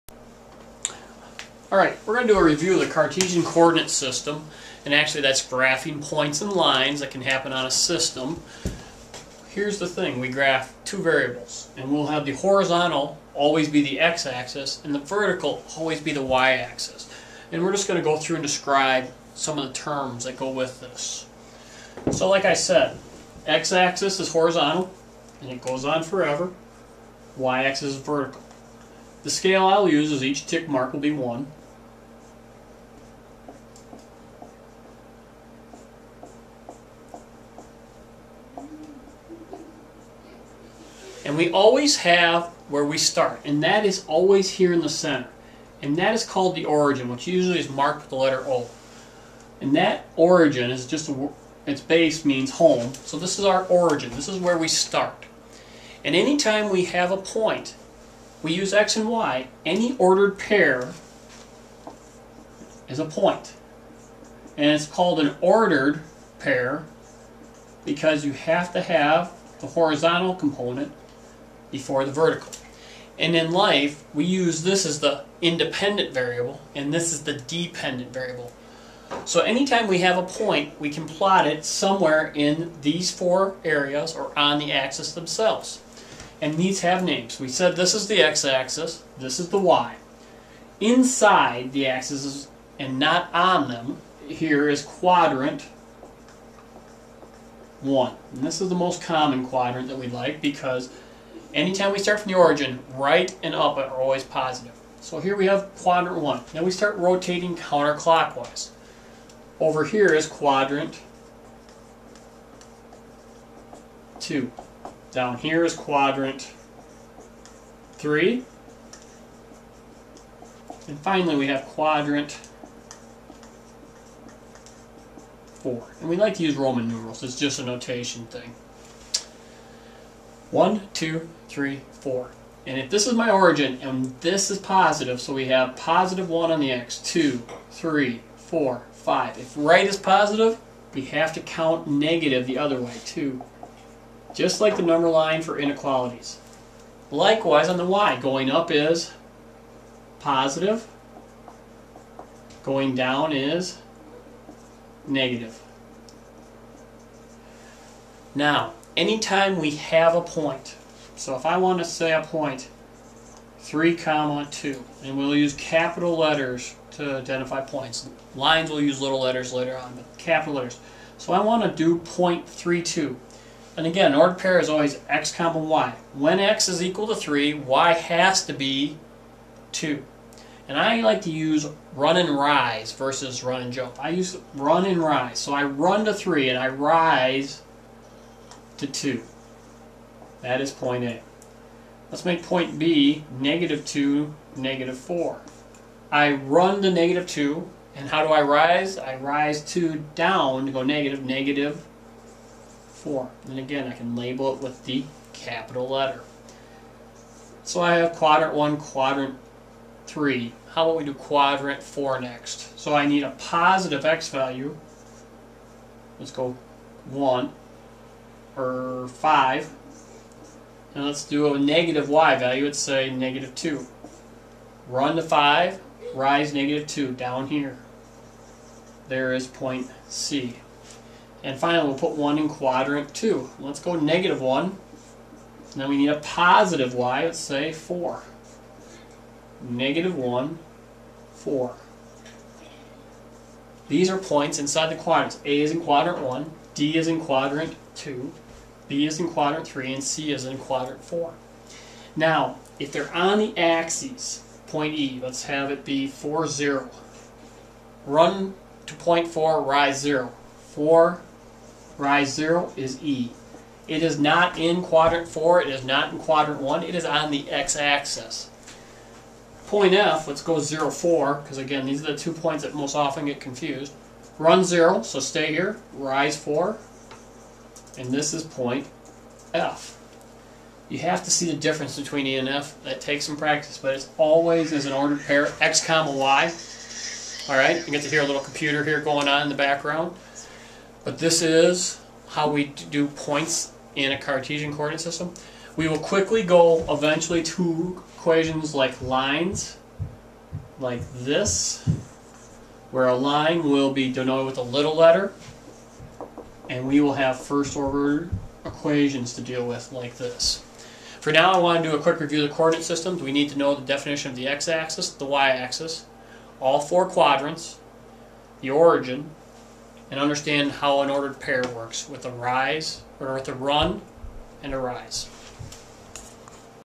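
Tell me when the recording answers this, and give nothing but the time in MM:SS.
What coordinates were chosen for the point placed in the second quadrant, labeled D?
03:59.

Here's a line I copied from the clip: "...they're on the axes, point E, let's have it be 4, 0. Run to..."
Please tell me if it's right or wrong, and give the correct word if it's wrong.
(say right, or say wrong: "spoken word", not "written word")
right.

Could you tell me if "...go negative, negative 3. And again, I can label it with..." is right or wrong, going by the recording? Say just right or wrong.
wrong.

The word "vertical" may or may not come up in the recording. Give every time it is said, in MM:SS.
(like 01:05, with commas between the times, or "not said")
00:14, 00:27, 01:12.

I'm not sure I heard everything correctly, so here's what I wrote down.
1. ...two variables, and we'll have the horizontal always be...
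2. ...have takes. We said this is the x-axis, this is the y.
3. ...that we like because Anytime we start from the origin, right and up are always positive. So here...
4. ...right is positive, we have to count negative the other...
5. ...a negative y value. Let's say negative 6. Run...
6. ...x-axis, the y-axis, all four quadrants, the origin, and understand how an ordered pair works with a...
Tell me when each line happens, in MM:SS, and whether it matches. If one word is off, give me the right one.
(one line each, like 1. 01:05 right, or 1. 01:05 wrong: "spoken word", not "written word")
1. 00:10 right
2. 01:26 wrong: "names", not "takes"
3. 01:39 right
4. 02:19 right
5. 03:41 wrong: "2", not "6"
6. 05:14 right.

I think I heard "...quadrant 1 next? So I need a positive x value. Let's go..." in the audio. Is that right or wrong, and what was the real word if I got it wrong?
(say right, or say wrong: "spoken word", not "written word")
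wrong: "4", not "1".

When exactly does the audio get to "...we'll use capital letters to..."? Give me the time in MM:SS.
02:45.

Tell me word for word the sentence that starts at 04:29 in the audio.
Point F, let's go 0, 4, because again, these are the two points that most often get confused.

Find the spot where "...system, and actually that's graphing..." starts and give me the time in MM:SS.
00:03.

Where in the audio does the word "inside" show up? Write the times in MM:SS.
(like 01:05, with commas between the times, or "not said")
01:30, 04:04.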